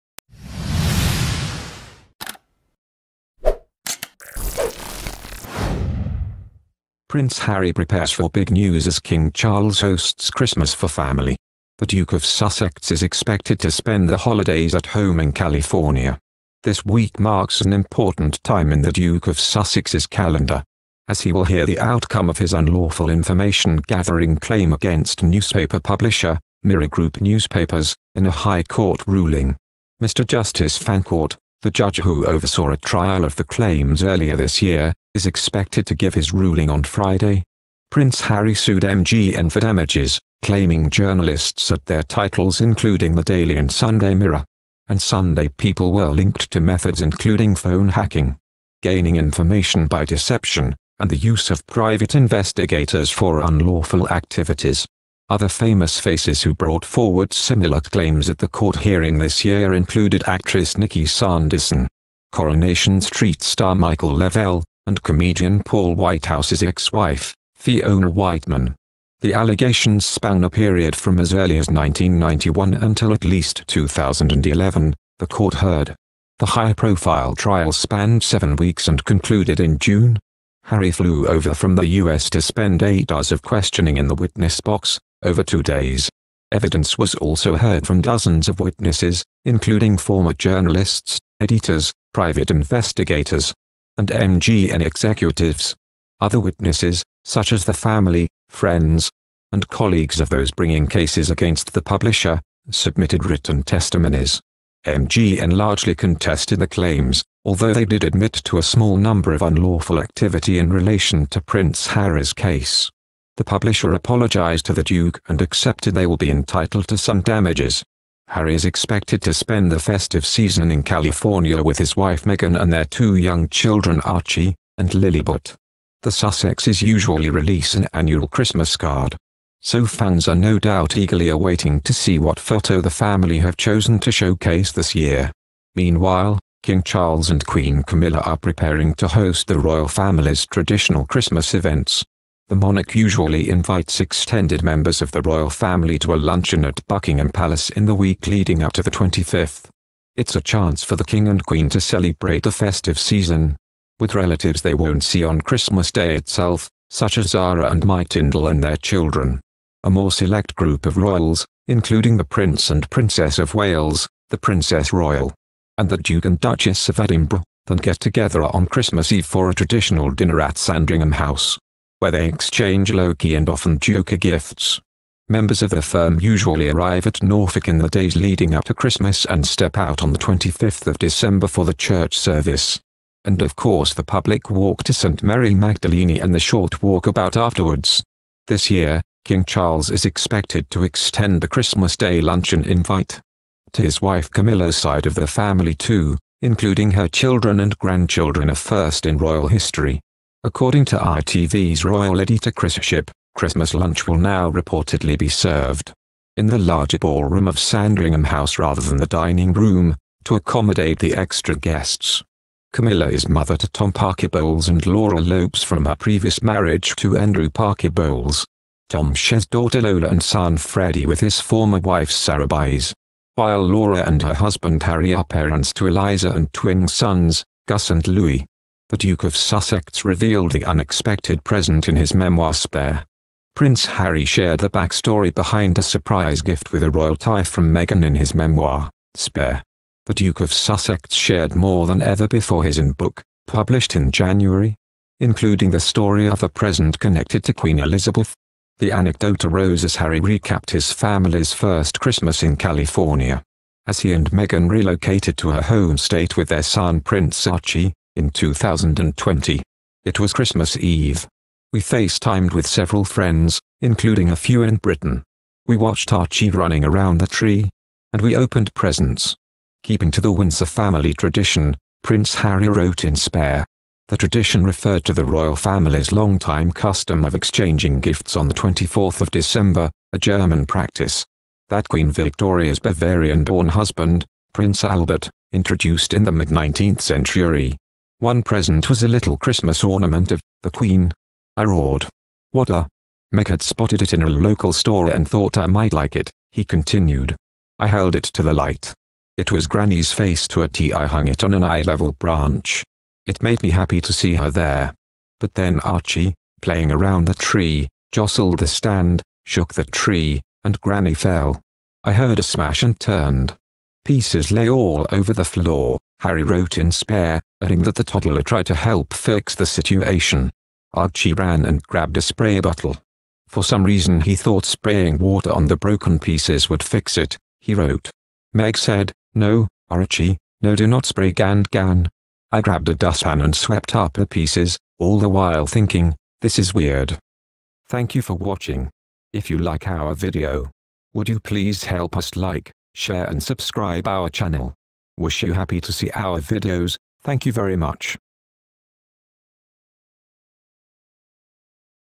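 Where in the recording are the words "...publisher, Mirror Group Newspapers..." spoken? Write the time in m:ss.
0:25.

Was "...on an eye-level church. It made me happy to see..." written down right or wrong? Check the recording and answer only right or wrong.
wrong.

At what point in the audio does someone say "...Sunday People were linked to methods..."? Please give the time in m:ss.
0:44.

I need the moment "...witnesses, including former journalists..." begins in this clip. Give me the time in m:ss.
1:28.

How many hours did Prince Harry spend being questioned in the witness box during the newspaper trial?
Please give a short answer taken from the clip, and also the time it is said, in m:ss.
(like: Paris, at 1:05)
8, at 1:22.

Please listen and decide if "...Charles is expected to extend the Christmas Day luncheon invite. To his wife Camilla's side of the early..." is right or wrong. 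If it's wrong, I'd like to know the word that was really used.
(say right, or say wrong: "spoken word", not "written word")
wrong: "family", not "early".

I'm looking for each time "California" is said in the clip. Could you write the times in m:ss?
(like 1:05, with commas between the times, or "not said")
0:15, 2:00, 4:12.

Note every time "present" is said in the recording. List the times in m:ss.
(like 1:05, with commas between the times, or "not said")
3:51, 4:06, 4:28, 4:48.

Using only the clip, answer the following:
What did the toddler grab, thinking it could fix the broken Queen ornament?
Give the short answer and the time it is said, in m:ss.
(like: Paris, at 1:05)
a spray bottle, at 5:22.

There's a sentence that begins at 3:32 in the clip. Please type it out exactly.
Camilla is mother to Tom Parker Bowles and Laura Lopes from her previous marriage to Andrew Parker Bowles.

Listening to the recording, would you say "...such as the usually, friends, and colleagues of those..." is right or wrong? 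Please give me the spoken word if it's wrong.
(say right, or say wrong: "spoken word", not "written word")
wrong: "family", not "usually".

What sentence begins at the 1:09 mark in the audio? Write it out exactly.
The allegations span a period from as early as 1991 until at least 2011, the court heard.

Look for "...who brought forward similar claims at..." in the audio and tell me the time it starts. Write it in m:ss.
0:56.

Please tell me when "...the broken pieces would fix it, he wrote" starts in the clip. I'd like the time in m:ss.
5:25.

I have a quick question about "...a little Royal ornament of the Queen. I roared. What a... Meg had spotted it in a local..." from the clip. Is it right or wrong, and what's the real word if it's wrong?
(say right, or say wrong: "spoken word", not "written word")
wrong: "Christmas", not "Royal".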